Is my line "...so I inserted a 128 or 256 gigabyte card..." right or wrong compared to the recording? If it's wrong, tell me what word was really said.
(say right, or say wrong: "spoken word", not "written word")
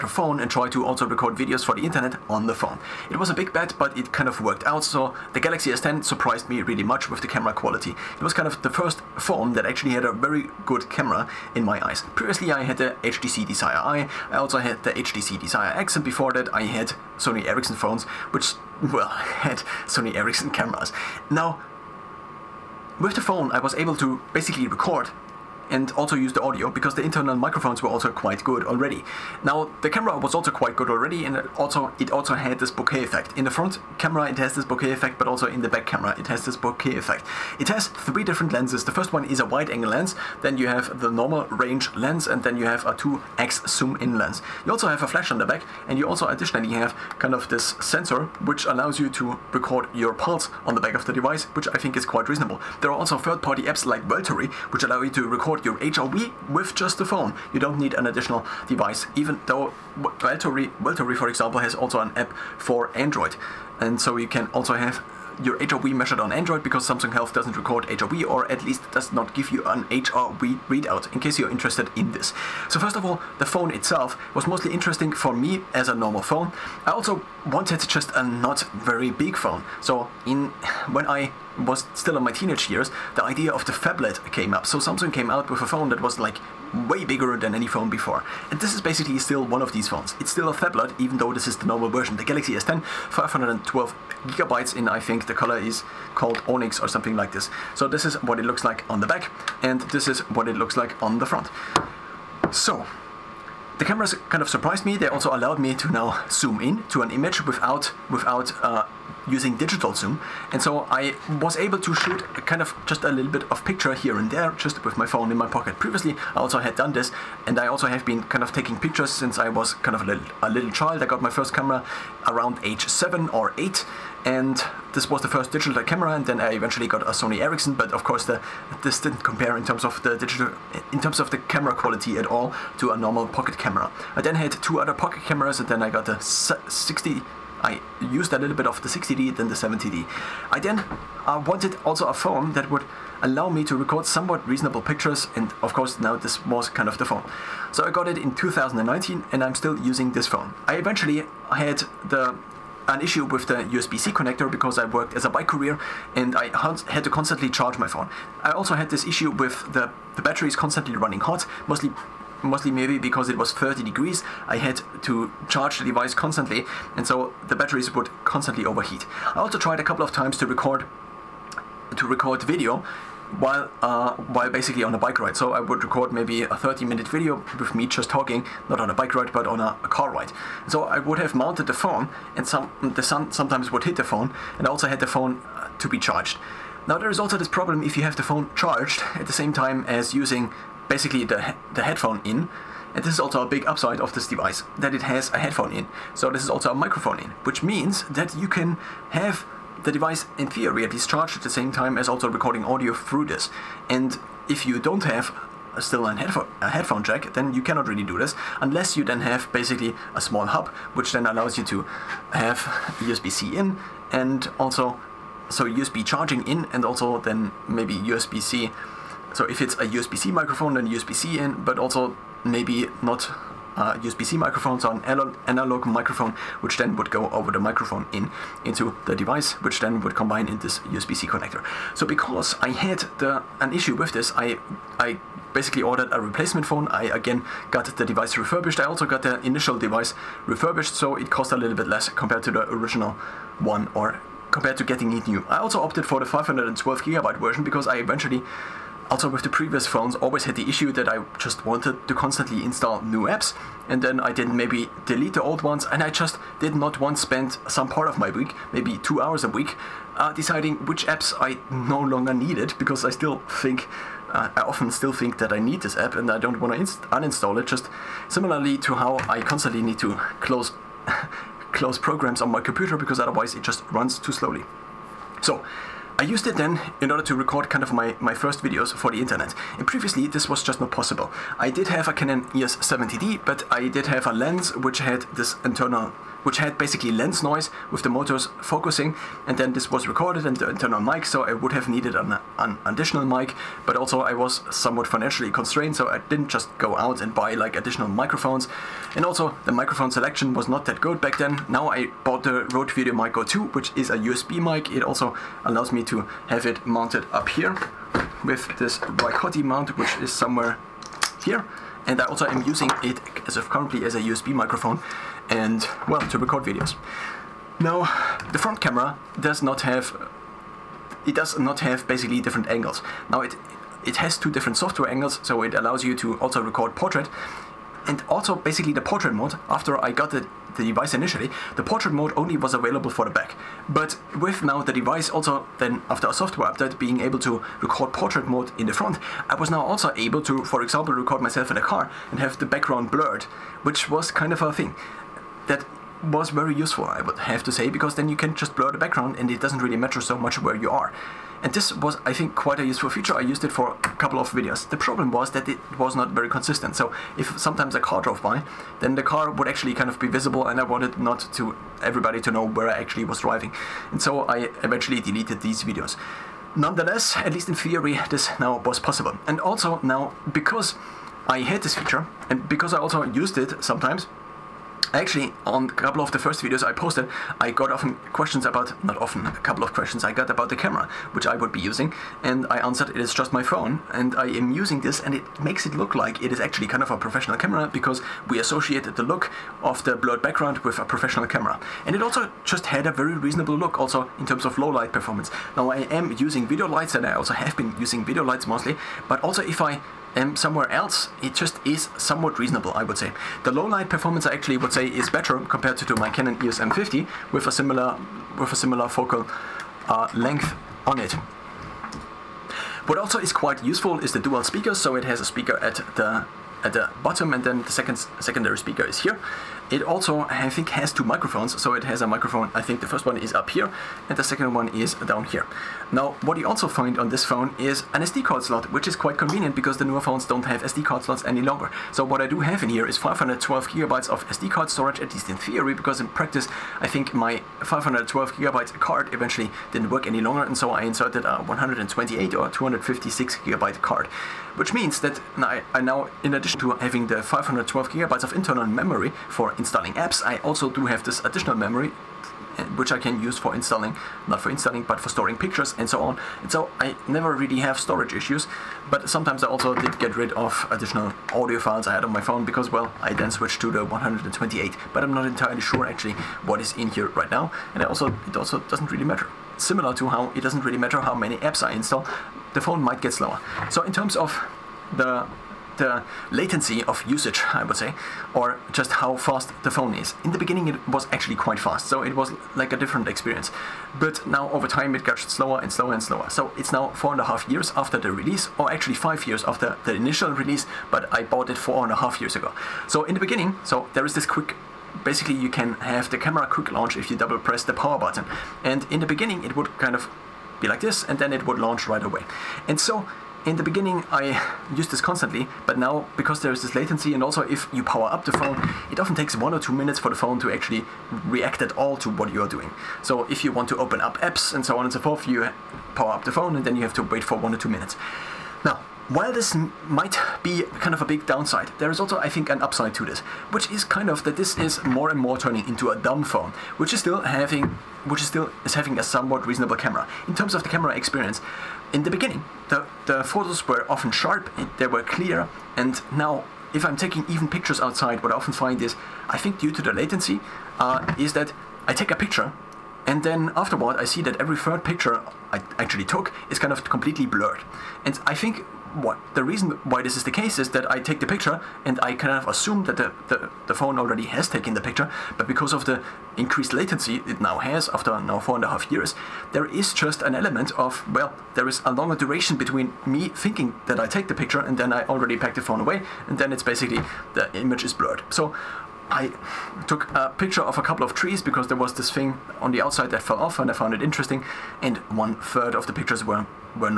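right.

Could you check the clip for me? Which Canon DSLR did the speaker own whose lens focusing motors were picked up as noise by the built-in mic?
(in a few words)
Canon EOS 70D.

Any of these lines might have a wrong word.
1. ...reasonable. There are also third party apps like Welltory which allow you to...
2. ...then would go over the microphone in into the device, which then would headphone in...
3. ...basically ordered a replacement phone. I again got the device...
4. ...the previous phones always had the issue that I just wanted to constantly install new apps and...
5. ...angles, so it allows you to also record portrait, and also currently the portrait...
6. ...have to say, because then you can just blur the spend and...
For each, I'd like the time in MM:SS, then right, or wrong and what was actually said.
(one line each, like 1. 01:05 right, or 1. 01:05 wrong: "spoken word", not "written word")
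1. 00:52 right
2. 03:46 wrong: "combine", not "headphone"
3. 03:55 right
4. 04:09 right
5. 05:25 wrong: "basically", not "currently"
6. 05:47 wrong: "background", not "spend".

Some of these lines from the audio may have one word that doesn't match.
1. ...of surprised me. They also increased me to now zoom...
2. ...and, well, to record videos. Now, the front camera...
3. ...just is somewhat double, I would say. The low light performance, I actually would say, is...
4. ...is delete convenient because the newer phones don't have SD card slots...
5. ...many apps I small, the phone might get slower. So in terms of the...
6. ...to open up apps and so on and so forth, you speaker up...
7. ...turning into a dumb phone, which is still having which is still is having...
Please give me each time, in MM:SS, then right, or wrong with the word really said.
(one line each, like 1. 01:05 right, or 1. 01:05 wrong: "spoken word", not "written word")
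1. 01:44 wrong: "allowed", not "increased"
2. 05:15 right
3. 06:41 wrong: "reasonable", not "double"
4. 07:09 wrong: "quite", not "delete"
5. 07:51 wrong: "install", not "small"
6. 08:33 wrong: "power", not "speaker"
7. 08:45 right.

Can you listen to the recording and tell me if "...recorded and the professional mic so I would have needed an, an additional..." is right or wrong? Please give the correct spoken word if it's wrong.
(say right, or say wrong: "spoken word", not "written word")
wrong: "internal", not "professional".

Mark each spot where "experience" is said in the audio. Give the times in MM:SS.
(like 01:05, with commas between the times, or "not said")
08:03, 08:51.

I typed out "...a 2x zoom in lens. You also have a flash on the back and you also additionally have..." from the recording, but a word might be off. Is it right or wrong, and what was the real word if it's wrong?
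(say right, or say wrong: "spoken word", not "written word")
right.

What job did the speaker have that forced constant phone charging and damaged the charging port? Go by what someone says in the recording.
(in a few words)
bike courier.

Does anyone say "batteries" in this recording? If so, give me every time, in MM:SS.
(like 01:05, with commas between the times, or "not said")
02:40, 02:47.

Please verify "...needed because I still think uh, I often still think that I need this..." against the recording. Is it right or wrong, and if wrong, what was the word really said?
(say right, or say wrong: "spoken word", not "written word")
right.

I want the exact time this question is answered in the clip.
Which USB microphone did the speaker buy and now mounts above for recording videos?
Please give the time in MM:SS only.
05:02.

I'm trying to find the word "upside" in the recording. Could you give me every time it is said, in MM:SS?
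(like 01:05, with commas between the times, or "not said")
03:13, 08:42.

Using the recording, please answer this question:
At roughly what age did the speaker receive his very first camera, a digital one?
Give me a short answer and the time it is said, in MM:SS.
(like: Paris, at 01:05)
7 or 8, at 02:02.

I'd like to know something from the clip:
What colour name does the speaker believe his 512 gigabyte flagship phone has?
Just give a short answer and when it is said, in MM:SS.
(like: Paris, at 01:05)
Onyx, at 01:36.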